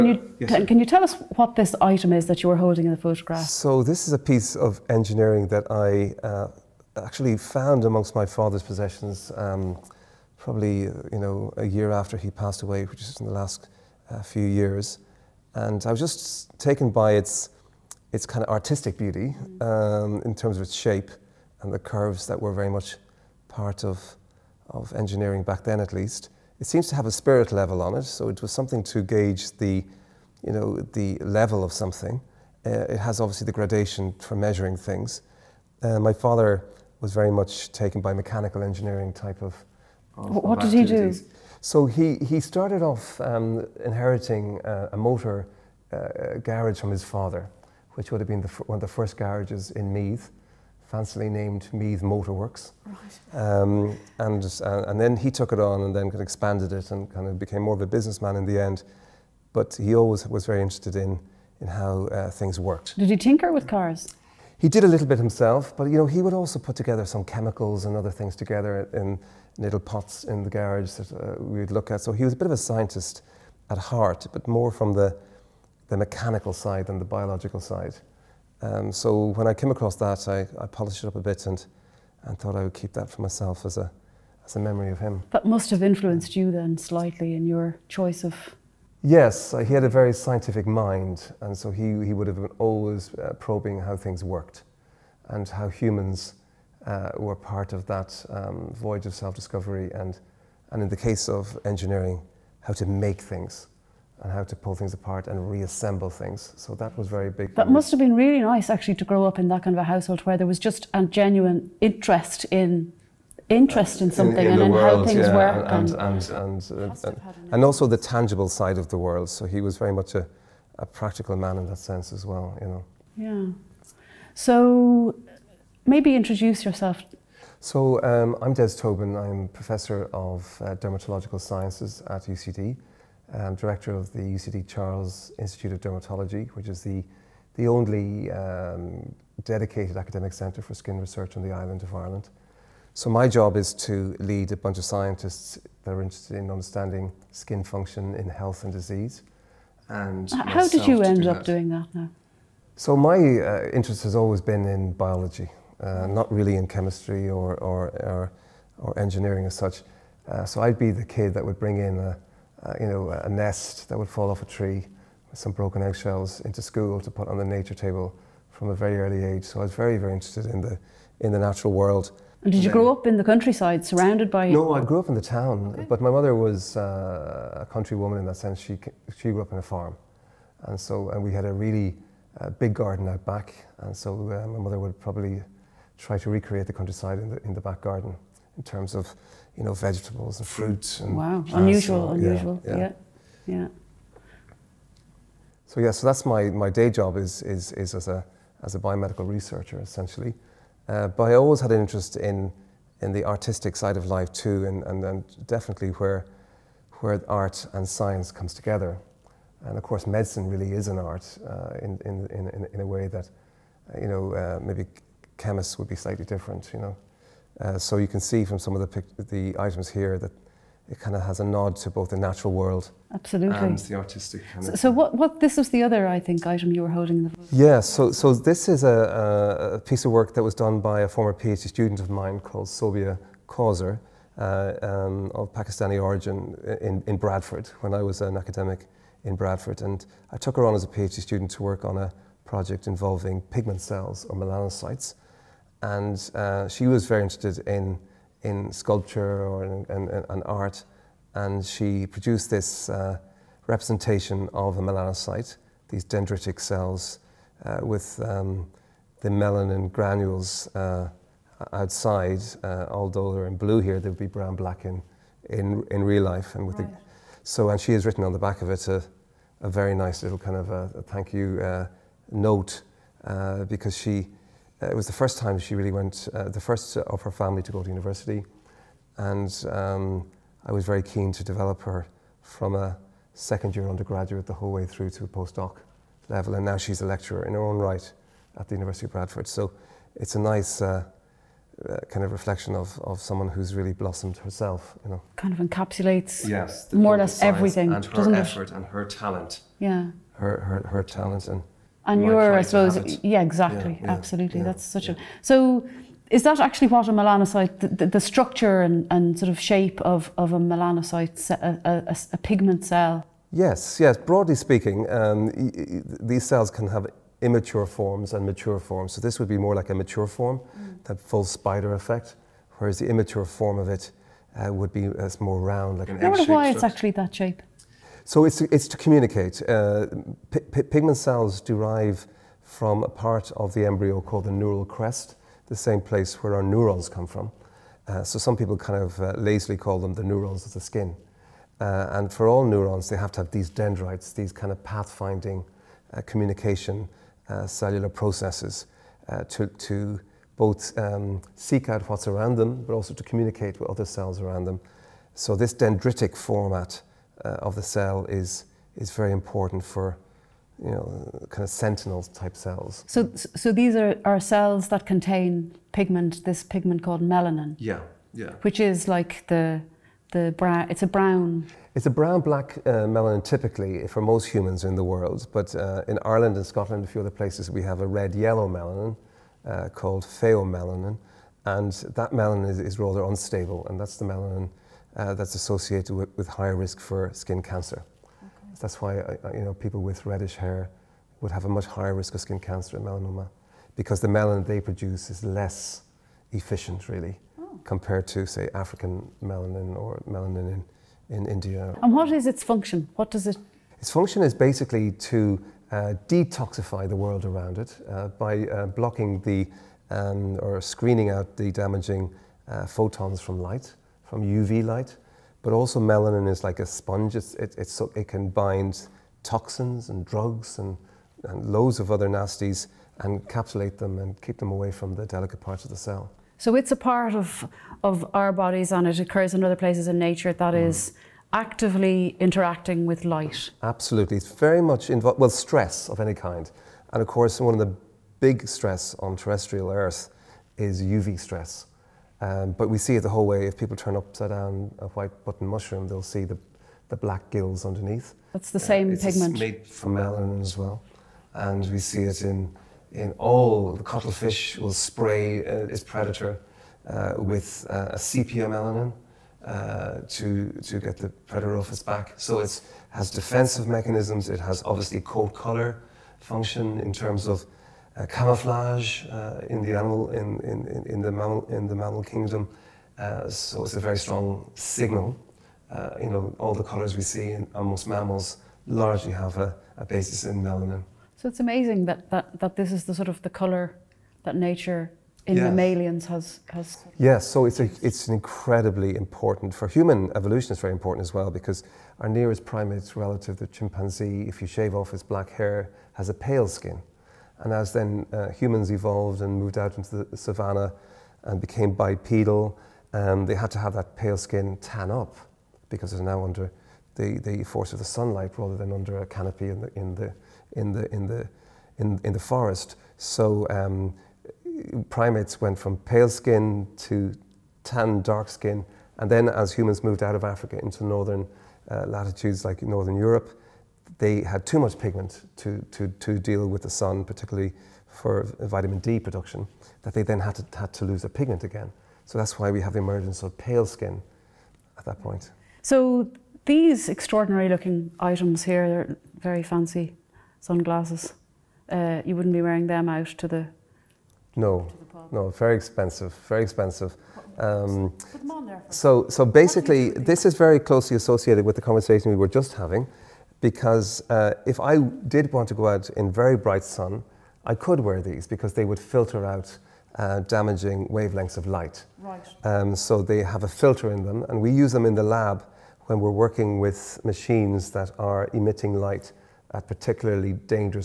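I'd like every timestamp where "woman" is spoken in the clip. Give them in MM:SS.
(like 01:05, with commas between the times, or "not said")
02:57.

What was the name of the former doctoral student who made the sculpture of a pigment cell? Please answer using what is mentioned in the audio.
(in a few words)
Sobia Kauser.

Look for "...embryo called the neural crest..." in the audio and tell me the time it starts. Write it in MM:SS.
05:33.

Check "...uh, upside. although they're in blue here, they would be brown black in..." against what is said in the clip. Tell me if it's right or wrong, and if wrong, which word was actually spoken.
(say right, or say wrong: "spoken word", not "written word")
wrong: "outside", not "upside".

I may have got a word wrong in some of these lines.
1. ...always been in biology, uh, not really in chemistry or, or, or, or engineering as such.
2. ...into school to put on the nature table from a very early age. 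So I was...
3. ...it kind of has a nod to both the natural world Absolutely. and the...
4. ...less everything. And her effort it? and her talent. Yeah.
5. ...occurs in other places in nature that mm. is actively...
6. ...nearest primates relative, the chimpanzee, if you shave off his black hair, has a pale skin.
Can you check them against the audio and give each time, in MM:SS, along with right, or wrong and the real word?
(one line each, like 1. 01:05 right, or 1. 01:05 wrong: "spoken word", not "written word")
1. 02:34 right
2. 02:46 right
3. 03:40 right
4. 04:57 right
5. 07:09 right
6. 08:12 right.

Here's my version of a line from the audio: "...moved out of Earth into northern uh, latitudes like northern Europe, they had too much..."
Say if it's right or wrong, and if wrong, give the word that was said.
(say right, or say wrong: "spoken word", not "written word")
wrong: "Africa", not "Earth".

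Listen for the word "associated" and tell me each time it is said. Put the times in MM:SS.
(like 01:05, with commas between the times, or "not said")
06:25, 09:11.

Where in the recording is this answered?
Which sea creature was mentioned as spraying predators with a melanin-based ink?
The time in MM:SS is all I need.
07:34.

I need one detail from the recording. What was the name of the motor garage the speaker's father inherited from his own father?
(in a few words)
Meath Motorworks.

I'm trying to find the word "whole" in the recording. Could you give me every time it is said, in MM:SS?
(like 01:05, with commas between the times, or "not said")
04:44, 07:23.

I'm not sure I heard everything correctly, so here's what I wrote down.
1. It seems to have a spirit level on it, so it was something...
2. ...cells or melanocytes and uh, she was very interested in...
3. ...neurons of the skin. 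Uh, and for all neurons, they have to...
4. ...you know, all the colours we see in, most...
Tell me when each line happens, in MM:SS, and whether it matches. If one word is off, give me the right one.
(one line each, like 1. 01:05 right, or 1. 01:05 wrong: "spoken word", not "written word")
1. 00:26 right
2. 04:03 right
3. 05:40 right
4. 07:56 right.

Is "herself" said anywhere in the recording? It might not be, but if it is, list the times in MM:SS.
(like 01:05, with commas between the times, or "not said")
04:54.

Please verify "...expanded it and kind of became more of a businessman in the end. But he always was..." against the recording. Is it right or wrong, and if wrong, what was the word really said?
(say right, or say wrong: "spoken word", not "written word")
right.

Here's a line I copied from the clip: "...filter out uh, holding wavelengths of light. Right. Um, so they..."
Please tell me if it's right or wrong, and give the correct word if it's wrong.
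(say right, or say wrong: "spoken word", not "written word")
wrong: "damaging", not "holding".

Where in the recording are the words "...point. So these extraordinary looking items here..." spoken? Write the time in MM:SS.
08:55.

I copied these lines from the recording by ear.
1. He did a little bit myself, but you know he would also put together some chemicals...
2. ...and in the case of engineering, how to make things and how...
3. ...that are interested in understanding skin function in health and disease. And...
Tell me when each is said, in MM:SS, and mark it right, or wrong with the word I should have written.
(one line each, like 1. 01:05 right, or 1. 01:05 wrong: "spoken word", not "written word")
1. 01:04 wrong: "himself", not "myself"
2. 01:40 right
3. 02:25 right.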